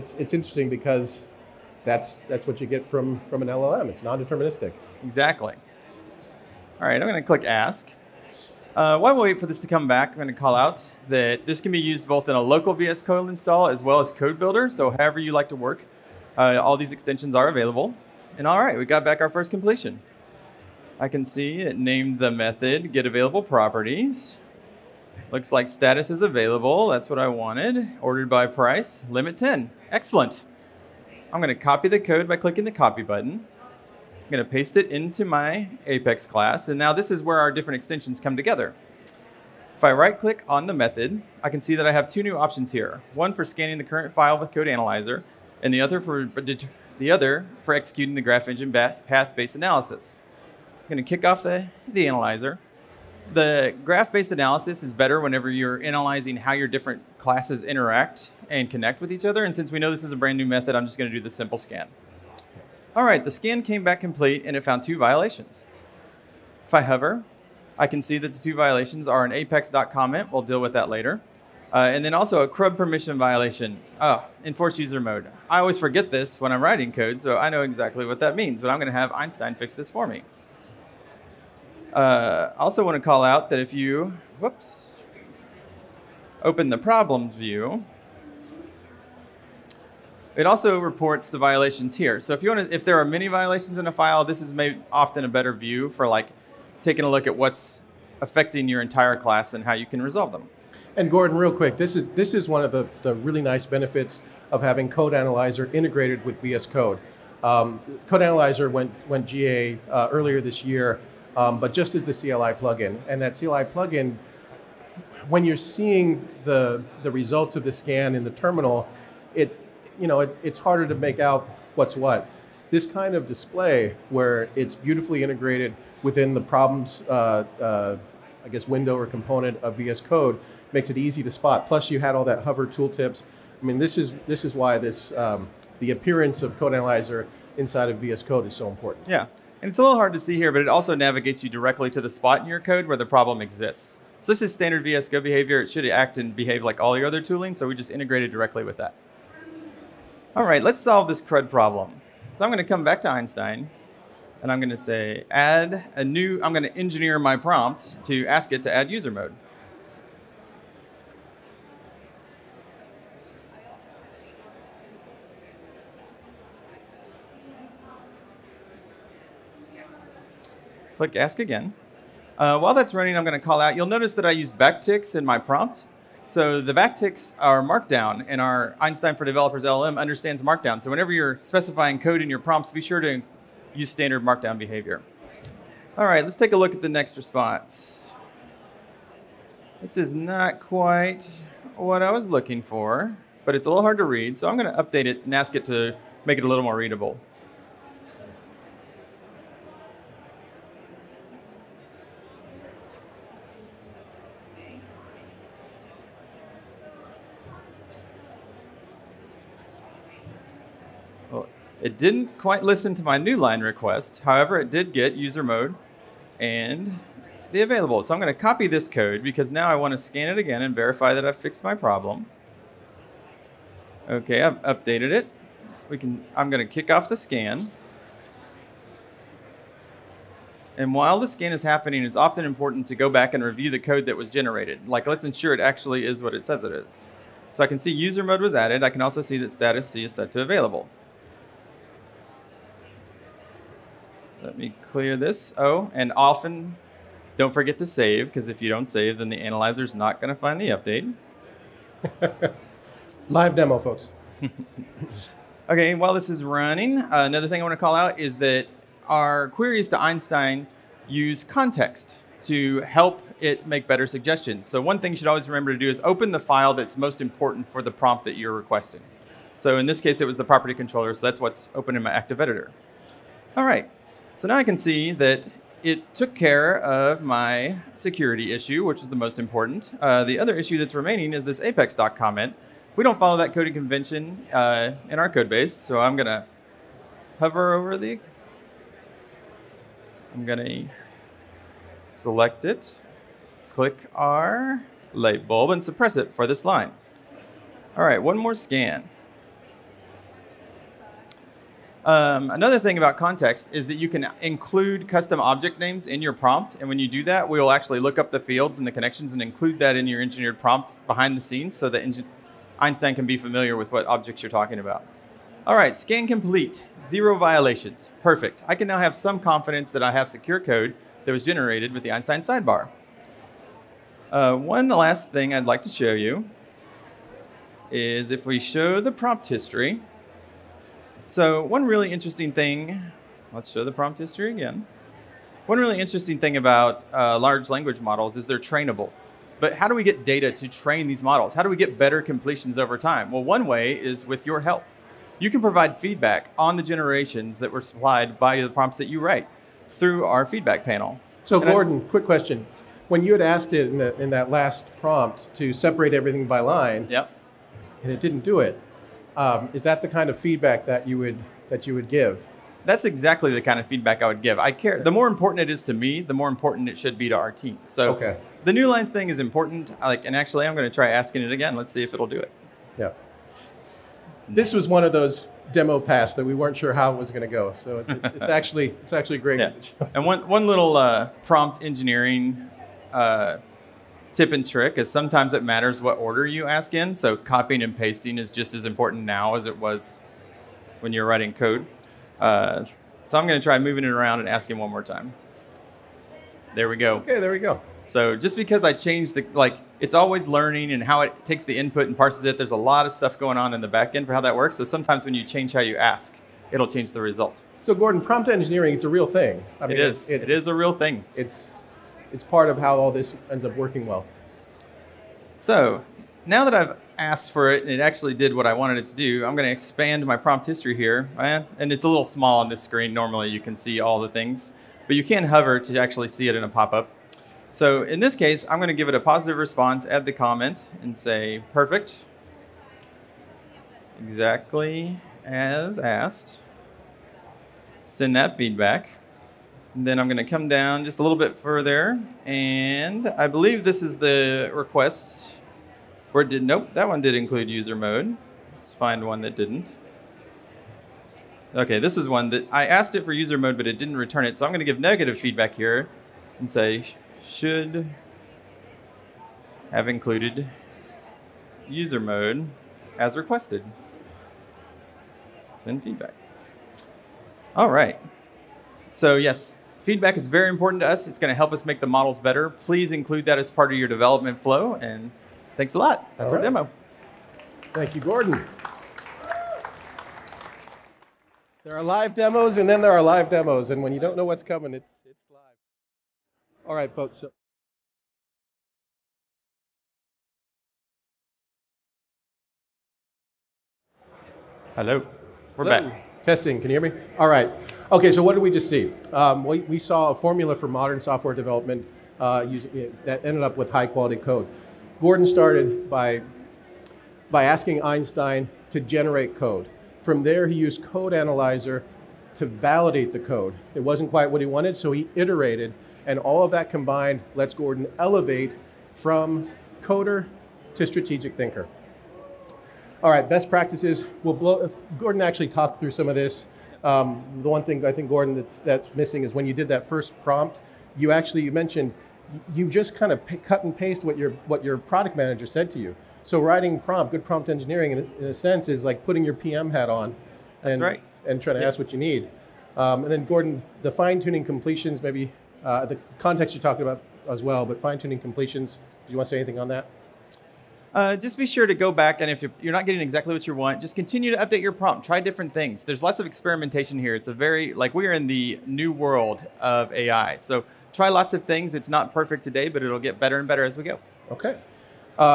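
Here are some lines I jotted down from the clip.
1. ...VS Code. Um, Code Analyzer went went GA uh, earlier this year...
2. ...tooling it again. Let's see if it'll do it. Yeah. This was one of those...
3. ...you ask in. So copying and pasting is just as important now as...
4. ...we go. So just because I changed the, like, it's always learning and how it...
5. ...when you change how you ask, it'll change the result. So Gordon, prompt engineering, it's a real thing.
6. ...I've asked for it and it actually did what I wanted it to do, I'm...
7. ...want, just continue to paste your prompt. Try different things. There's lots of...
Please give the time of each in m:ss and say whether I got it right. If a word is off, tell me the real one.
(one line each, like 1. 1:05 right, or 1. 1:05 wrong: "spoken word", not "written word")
1. 1:46 right
2. 6:11 wrong: "asking", not "tooling"
3. 6:26 right
4. 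6:37 right
5. 6:45 right
6. 6:56 right
7. 9:13 wrong: "update", not "paste".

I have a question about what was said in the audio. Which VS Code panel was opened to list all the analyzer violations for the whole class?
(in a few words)
problems view.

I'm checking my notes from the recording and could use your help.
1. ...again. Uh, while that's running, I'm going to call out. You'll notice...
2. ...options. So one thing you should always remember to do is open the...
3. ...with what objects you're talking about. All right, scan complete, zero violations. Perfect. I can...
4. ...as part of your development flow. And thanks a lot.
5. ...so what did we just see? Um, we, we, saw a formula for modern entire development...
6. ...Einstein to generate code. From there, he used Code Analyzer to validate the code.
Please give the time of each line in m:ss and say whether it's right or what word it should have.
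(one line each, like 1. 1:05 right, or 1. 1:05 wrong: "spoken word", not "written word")
1. 2:51 right
2. 4:24 wrong: "suggestions", not "options"
3. 5:13 right
4. 7:53 right
5. 8:18 wrong: "software", not "entire"
6. 8:28 right.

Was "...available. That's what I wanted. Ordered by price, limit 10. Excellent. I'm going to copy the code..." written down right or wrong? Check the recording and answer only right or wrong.
right.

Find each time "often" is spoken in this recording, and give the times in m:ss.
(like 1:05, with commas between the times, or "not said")
1:34, 3:52, 4:06.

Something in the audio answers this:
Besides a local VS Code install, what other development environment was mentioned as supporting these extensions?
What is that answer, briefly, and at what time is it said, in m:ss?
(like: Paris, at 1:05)
Code Builder, at 0:14.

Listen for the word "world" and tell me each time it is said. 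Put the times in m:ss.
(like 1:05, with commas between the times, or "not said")
9:19.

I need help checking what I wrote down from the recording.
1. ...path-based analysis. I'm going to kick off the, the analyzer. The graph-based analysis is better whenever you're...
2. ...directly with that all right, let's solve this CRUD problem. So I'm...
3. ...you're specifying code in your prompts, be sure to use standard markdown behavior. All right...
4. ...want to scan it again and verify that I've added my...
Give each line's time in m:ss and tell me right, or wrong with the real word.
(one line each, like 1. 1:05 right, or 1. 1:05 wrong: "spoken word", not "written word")
1. 0:48 right
2. 2:28 right
3. 3:01 right
4. 3:39 wrong: "fixed", not "added".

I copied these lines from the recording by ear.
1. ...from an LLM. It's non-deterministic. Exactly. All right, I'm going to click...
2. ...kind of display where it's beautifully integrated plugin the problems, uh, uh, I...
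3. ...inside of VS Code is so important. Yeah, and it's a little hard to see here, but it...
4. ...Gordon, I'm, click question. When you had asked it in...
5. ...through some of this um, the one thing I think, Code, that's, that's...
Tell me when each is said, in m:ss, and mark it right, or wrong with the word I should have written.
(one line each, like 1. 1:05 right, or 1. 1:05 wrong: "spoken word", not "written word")
1. 0:03 right
2. 2:02 wrong: "within", not "plugin"
3. 2:17 right
4. 5:51 wrong: "quick", not "click"
5. 8:45 wrong: "Gordon", not "Code".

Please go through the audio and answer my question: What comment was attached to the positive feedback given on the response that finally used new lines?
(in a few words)
perfect, exactly as asked.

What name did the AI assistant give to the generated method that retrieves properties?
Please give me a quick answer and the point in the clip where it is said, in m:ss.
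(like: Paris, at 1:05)
get available properties, at 0:22.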